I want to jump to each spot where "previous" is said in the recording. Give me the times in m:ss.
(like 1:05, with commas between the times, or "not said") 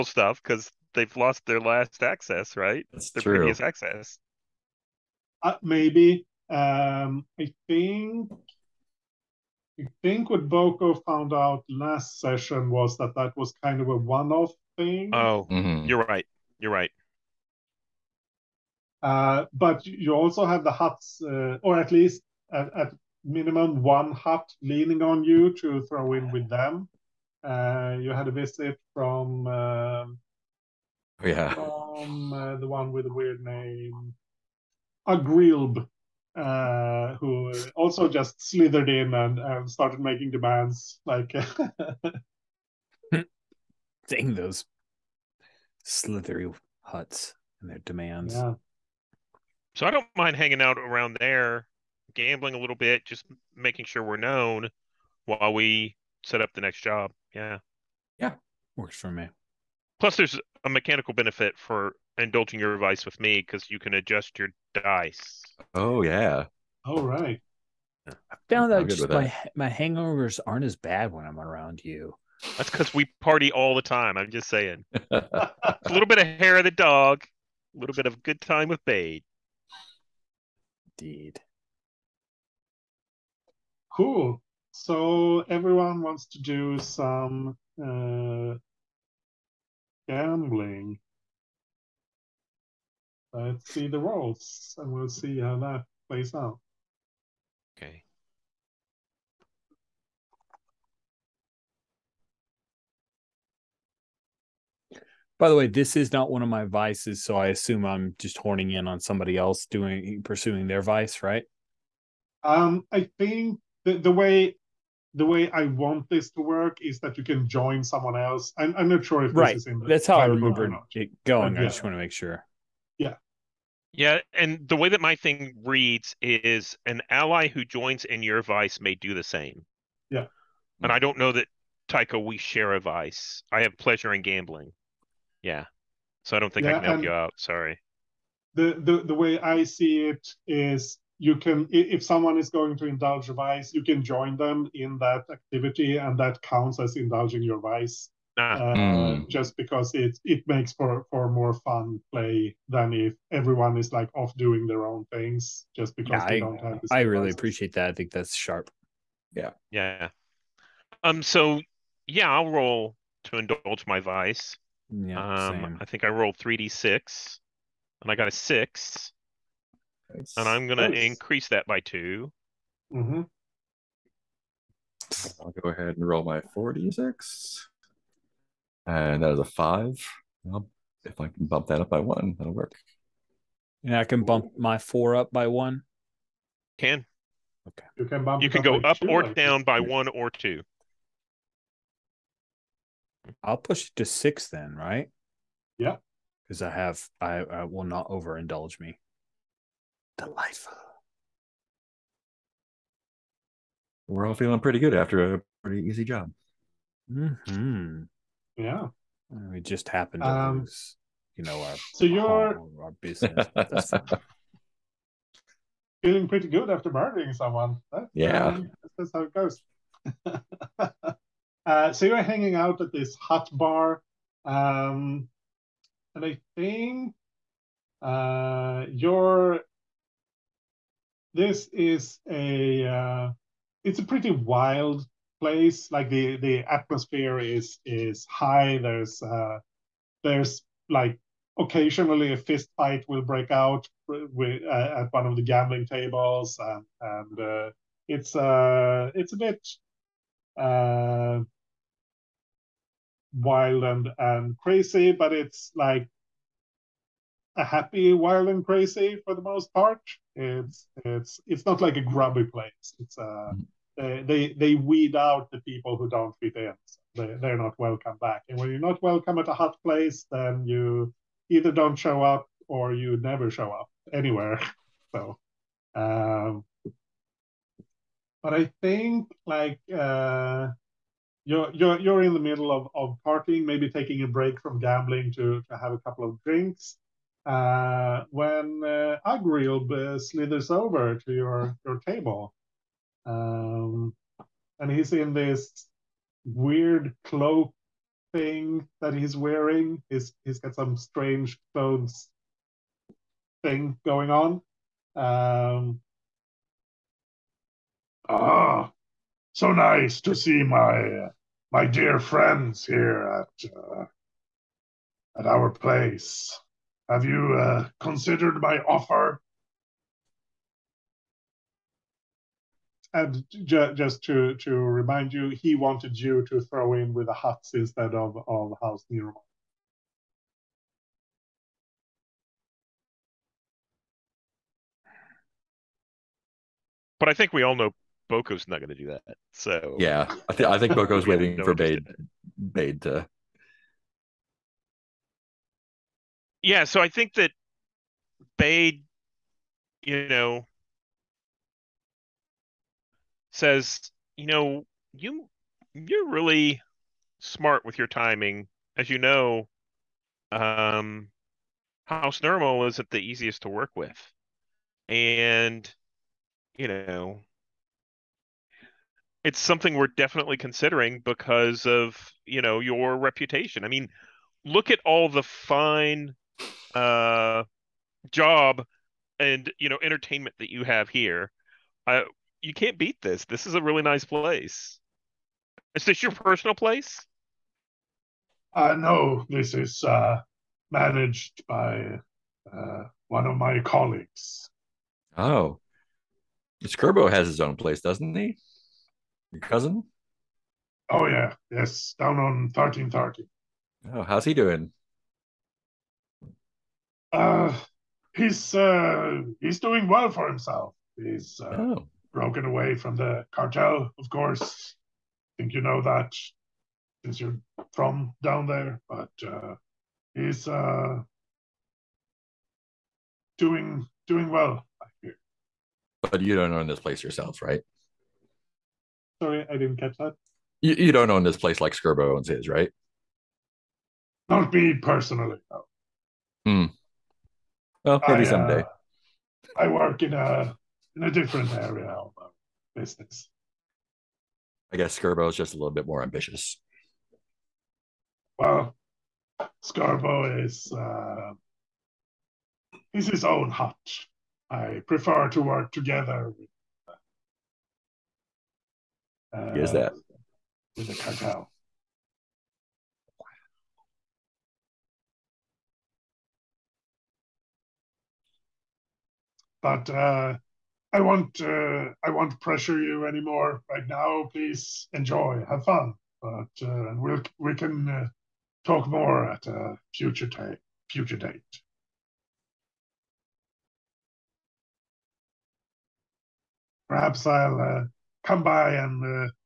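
0:03.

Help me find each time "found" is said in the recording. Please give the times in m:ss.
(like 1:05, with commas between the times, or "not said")
0:11, 1:08.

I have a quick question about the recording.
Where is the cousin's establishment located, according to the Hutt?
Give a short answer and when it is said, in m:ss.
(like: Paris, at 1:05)
thirteen thirty, at 6:42.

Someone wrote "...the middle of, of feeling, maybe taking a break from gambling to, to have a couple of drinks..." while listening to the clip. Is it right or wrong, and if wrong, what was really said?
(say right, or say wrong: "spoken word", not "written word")
wrong: "partying", not "feeling".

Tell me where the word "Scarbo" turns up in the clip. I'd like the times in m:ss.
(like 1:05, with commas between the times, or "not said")
6:37, 7:11, 7:25, 7:29.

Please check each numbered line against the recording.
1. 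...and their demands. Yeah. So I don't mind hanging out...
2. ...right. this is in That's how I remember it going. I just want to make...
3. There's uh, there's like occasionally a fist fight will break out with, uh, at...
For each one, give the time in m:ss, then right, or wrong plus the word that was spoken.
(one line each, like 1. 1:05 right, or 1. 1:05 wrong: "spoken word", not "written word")
1. 0:47 right
2. 1:59 right
3. 3:58 right.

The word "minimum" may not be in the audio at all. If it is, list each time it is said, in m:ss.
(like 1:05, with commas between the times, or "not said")
0:23.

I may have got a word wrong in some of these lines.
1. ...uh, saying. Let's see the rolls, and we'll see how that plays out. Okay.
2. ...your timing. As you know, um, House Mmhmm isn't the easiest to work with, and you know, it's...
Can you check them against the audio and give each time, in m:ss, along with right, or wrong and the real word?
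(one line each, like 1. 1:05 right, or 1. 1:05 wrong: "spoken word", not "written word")
1. 1:27 wrong: "gambling", not "saying"
2. 5:57 wrong: "Nirmal", not "Mmhmm".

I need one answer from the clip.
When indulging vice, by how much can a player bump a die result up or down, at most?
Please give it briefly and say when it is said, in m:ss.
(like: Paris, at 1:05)
2, at 3:08.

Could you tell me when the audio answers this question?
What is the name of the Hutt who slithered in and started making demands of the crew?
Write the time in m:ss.
0:35.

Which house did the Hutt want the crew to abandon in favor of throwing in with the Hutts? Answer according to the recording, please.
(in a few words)
House Nero.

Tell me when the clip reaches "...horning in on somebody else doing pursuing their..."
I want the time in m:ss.
1:48.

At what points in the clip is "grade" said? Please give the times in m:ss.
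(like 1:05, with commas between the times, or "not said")
not said.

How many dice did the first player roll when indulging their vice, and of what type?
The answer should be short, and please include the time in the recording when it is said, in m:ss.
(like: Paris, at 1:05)
3d6, at 2:46.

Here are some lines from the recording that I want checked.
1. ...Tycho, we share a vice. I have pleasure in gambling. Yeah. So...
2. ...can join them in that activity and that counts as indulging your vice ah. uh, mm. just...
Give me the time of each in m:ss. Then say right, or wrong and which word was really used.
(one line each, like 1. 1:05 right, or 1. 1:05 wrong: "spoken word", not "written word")
1. 2:11 right
2. 2:23 right.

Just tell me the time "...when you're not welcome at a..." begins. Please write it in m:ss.
4:28.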